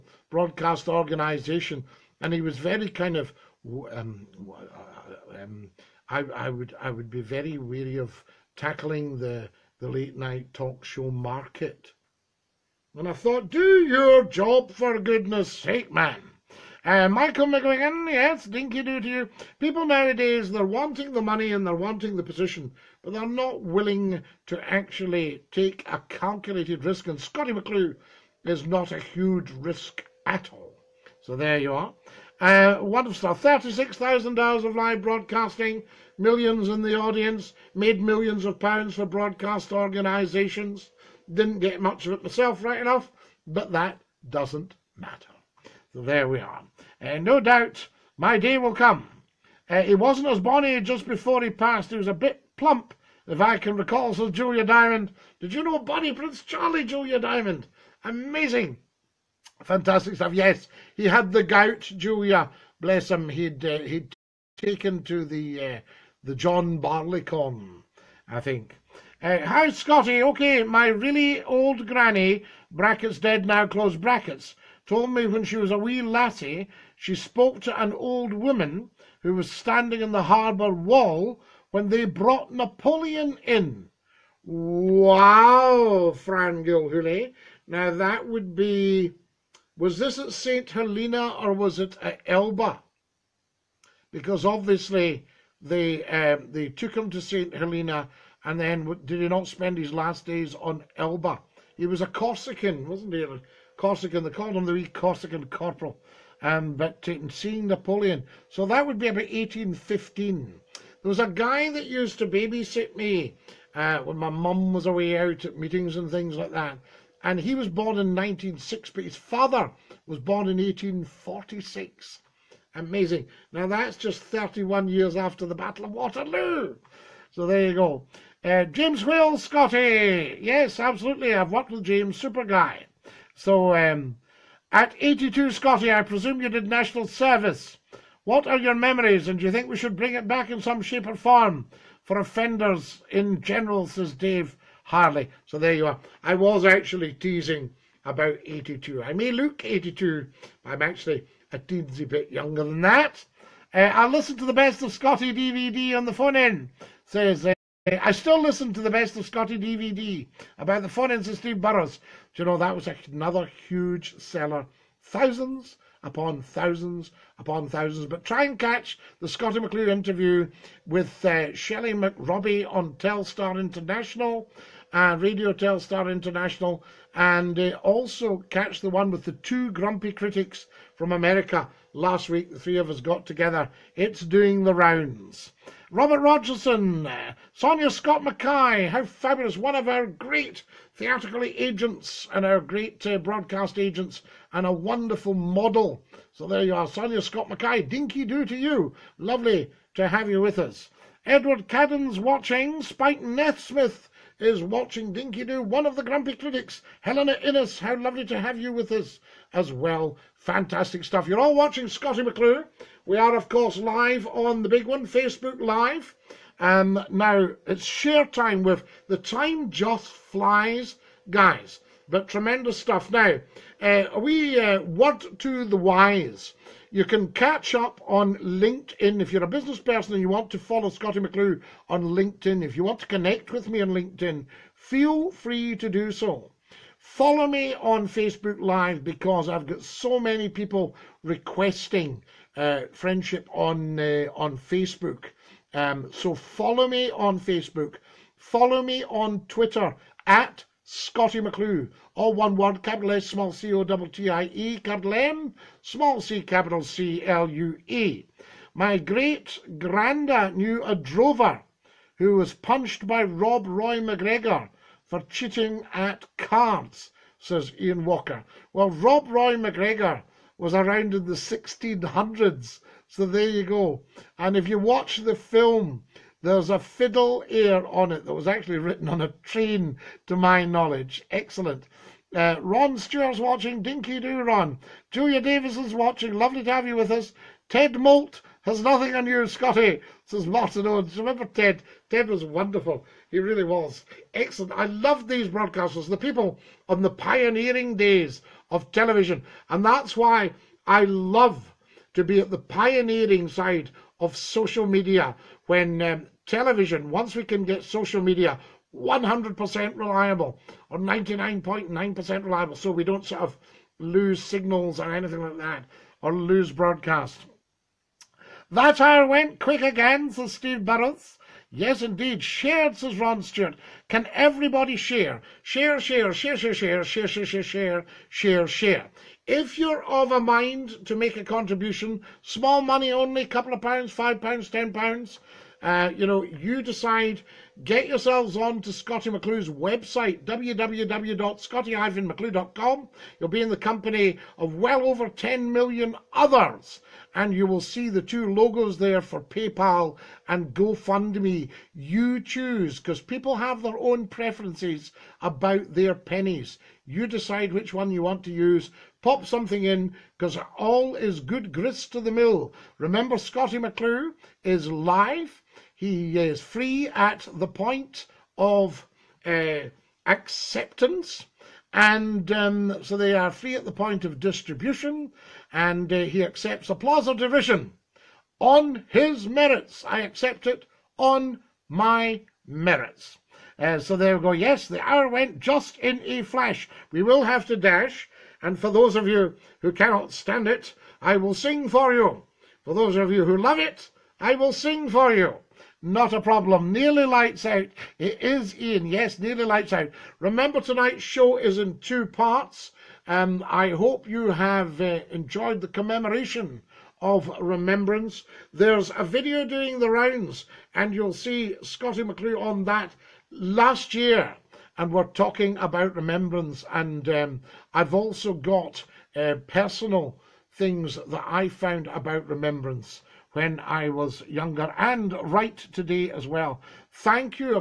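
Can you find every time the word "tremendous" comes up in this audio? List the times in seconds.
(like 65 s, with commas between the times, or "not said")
222 s.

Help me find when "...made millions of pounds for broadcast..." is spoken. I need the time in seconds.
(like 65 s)
37 s.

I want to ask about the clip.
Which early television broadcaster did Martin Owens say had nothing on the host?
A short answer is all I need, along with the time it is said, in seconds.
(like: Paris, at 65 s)
Ted Moult, at 287 s.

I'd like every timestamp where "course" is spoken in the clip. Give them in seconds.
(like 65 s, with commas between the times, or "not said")
213 s.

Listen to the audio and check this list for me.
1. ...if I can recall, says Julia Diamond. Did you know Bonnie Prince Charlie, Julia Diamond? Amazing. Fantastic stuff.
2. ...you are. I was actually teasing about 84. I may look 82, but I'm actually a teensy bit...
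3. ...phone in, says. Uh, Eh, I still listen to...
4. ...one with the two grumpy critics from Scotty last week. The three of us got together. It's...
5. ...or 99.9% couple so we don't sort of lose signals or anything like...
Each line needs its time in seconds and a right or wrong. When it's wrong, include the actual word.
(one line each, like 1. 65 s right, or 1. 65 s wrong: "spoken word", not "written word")
1. 53 s right
2. 145 s wrong: "82", not "84"
3. 156 s right
4. 178 s wrong: "America", not "Scotty"
5. 310 s wrong: "reliable", not "couple".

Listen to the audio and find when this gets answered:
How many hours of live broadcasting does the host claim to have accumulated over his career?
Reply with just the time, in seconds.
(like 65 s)
33 s.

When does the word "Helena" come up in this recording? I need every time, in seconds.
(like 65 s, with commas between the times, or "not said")
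90 s, 97 s, 206 s.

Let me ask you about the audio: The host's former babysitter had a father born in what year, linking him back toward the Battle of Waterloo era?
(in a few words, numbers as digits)
1846.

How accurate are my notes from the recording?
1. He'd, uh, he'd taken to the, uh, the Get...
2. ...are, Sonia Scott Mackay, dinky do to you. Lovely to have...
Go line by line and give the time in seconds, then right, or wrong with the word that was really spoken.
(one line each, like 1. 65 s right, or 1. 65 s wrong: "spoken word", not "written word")
1. 63 s wrong: "John", not "Get"
2. 196 s right.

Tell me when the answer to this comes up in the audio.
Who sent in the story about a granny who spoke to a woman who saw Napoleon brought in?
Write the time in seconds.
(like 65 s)
86 s.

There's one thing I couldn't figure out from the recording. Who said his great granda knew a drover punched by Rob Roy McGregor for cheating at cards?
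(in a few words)
Ian Walker.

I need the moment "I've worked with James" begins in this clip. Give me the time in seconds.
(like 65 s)
131 s.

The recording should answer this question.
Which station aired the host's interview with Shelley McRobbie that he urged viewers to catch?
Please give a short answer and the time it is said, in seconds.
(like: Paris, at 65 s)
Radio Telstar International, at 175 s.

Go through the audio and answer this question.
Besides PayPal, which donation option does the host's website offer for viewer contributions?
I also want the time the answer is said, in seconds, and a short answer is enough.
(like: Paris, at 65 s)
GoFundMe, at 350 s.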